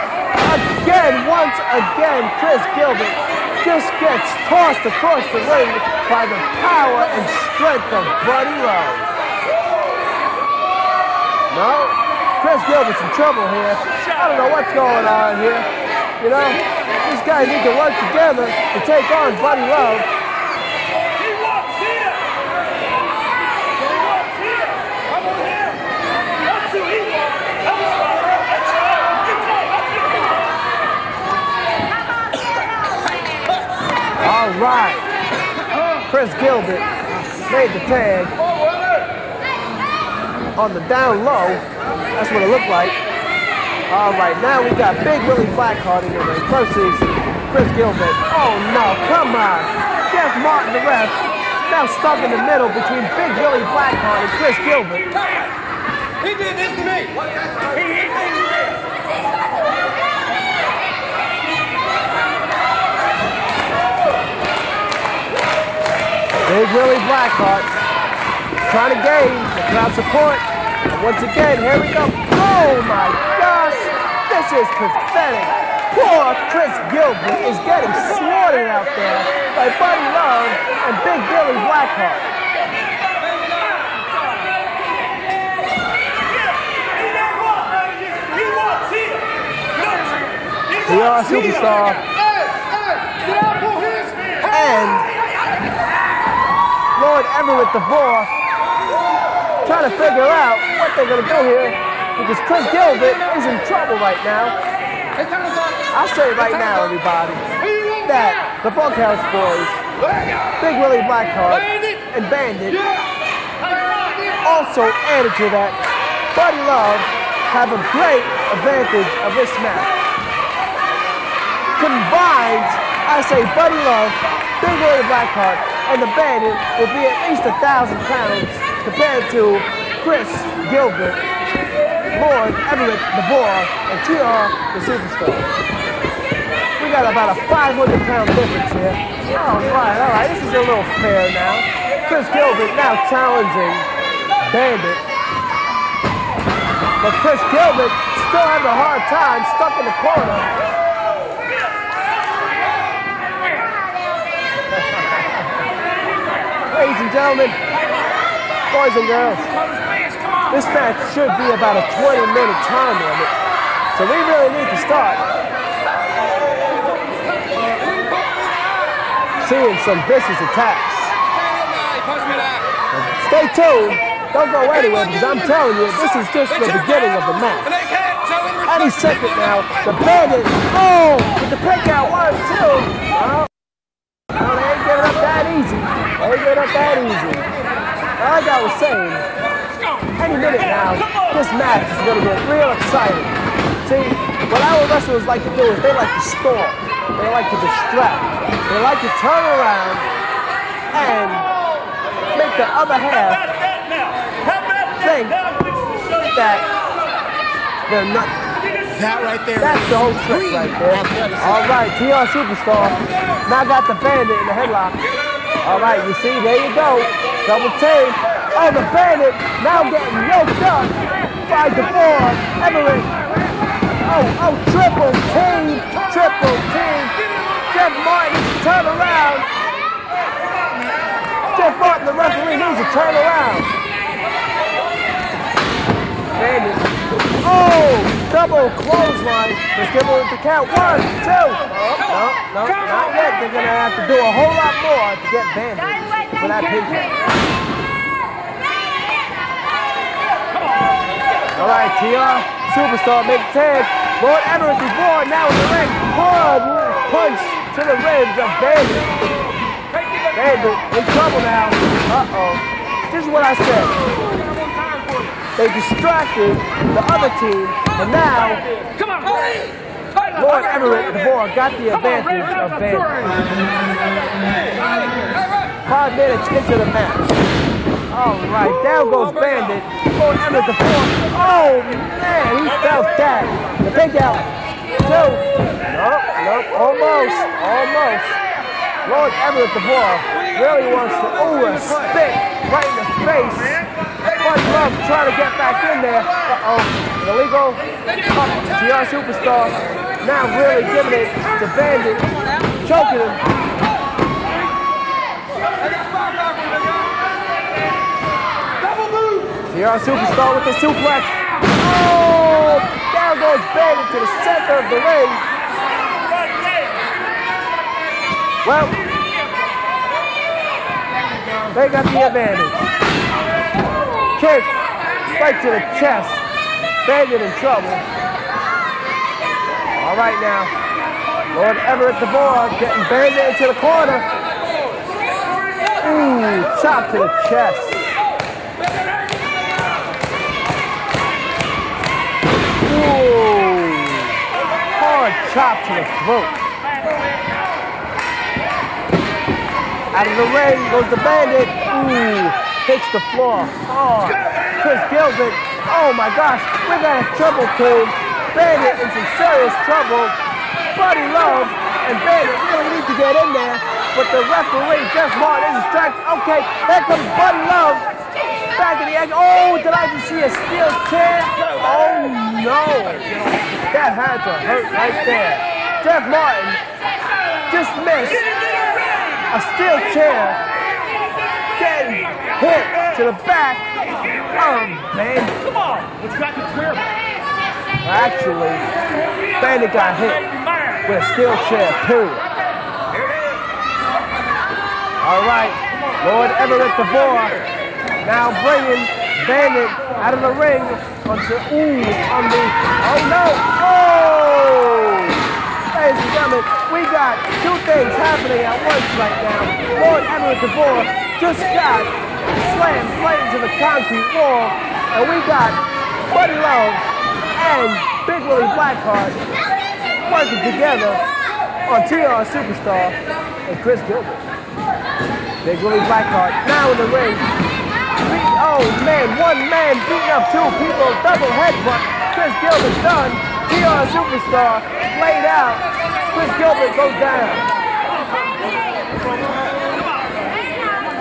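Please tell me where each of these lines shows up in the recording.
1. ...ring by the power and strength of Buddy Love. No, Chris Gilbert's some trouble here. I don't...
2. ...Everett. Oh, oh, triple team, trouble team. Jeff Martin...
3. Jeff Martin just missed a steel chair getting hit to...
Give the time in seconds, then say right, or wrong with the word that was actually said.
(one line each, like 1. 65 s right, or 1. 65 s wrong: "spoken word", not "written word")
1. 5 s right
2. 222 s wrong: "triple", not "trouble"
3. 376 s right.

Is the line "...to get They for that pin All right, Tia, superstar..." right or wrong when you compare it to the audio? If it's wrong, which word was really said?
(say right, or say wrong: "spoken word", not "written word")
wrong: "Bandit", not "They".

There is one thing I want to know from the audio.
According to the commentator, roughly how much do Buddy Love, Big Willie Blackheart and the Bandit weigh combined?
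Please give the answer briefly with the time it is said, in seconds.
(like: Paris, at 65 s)
1,000 pounds, at 127 s.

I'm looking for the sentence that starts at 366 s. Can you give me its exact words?
Okay, there comes Buddy Love see a steel chair.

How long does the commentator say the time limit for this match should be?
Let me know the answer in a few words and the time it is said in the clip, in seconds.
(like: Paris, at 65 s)
20 minutes, at 161 s.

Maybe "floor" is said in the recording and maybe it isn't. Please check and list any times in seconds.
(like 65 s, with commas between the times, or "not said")
280 s, 353 s.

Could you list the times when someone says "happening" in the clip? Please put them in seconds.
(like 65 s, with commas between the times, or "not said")
408 s.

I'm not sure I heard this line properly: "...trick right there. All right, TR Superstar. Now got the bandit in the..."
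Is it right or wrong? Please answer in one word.
right.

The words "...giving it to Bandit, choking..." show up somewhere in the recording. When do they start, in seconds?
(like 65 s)
300 s.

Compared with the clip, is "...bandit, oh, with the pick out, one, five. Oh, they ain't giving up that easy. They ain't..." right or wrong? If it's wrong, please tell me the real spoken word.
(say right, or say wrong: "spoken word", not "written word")
wrong: "two", not "five".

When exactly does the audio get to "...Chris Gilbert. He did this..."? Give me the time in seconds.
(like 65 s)
54 s.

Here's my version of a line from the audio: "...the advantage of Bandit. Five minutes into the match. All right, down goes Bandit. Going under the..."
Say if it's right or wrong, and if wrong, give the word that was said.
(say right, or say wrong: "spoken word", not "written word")
right.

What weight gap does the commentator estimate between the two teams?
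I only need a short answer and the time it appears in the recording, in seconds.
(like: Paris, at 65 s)
500 pounds, at 137 s.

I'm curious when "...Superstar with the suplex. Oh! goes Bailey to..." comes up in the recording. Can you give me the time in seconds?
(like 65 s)
309 s.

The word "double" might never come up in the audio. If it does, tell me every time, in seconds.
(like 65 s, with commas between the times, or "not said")
217 s, 238 s, 431 s.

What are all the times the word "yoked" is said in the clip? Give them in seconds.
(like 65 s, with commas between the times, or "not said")
220 s.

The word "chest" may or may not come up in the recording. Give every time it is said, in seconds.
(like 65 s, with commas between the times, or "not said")
325 s, 337 s.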